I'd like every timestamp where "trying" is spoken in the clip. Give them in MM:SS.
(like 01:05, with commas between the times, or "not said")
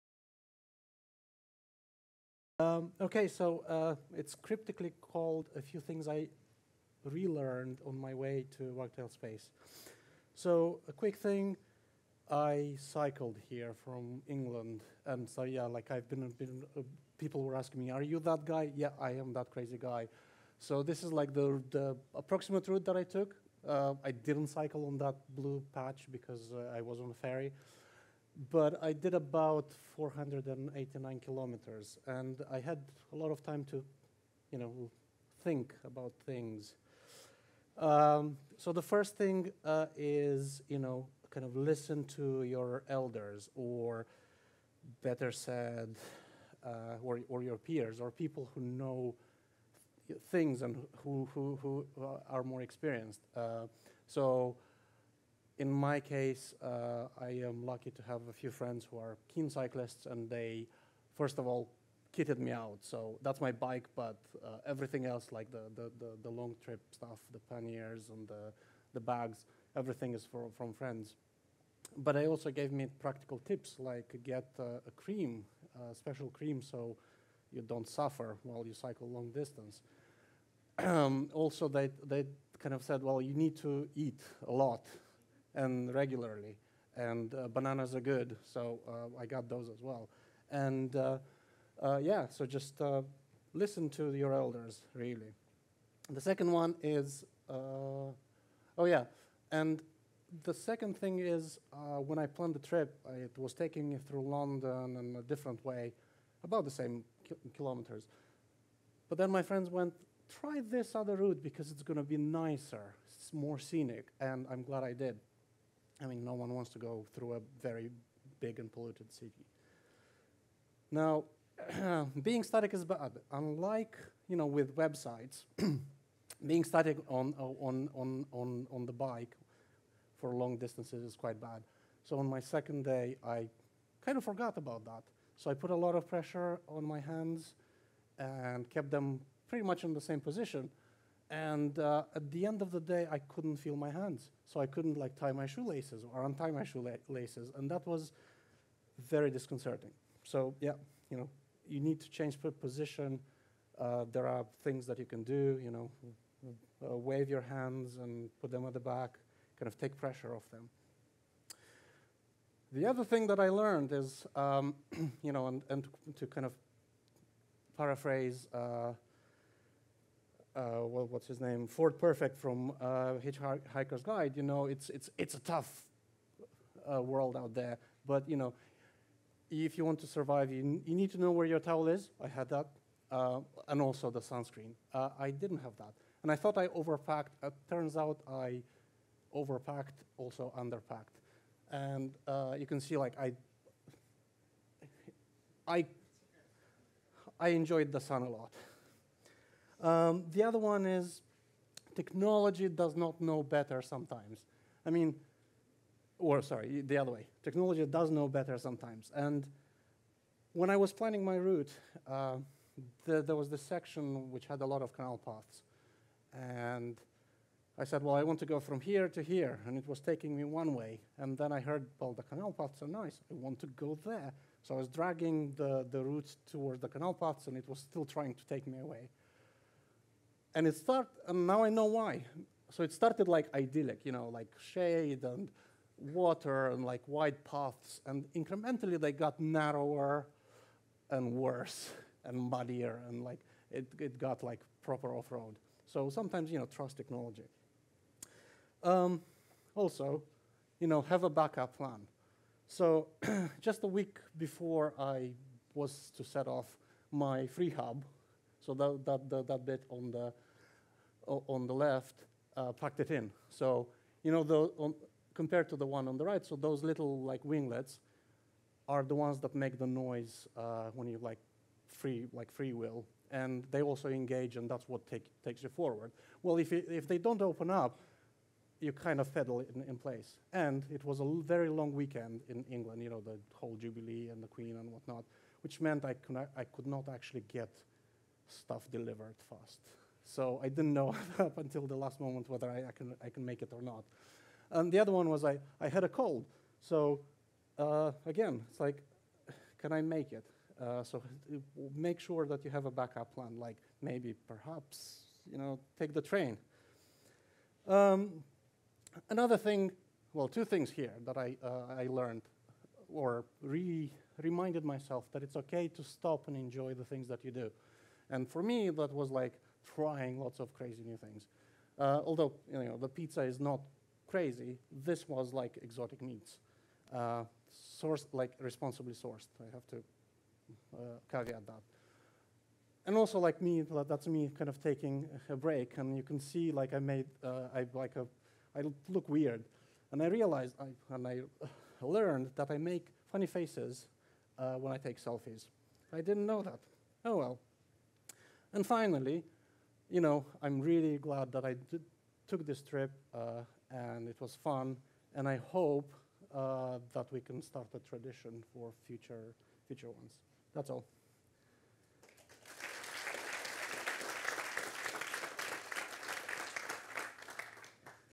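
03:48, 05:19.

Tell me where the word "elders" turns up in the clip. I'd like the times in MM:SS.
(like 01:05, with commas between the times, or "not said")
00:42, 01:34.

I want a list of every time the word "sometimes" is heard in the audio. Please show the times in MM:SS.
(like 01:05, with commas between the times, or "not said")
03:23, 03:28, 04:06.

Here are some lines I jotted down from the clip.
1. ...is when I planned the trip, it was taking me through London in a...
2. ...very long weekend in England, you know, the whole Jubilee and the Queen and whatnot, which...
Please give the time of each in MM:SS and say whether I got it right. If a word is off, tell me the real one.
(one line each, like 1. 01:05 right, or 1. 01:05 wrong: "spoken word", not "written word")
1. 01:41 right
2. 04:41 right.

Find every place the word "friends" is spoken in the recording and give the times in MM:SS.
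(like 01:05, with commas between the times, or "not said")
00:58, 01:10, 01:49.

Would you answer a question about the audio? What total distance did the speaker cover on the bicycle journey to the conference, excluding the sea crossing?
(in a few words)
489 kilometers.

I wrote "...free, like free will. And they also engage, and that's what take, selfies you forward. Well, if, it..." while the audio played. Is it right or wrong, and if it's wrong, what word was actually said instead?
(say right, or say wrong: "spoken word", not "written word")
wrong: "takes", not "selfies".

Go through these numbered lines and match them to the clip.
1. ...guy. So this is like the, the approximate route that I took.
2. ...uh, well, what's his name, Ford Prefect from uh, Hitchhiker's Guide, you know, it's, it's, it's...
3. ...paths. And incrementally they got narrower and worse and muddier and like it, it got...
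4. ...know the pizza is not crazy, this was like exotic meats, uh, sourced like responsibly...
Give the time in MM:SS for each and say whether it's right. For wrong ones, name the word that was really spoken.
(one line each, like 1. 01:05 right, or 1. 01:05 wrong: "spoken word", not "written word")
1. 00:19 right
2. 02:50 right
3. 03:57 right
4. 05:22 right.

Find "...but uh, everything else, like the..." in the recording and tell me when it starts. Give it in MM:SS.
01:03.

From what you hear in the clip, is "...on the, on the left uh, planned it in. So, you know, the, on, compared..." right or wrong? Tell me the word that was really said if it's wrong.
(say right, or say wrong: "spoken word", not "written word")
wrong: "packed", not "planned".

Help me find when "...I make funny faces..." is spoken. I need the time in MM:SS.
05:42.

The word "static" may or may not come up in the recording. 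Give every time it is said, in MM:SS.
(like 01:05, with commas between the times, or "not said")
02:02, 02:06.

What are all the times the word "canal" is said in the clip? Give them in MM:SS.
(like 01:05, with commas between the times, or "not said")
03:34, 03:42, 03:46.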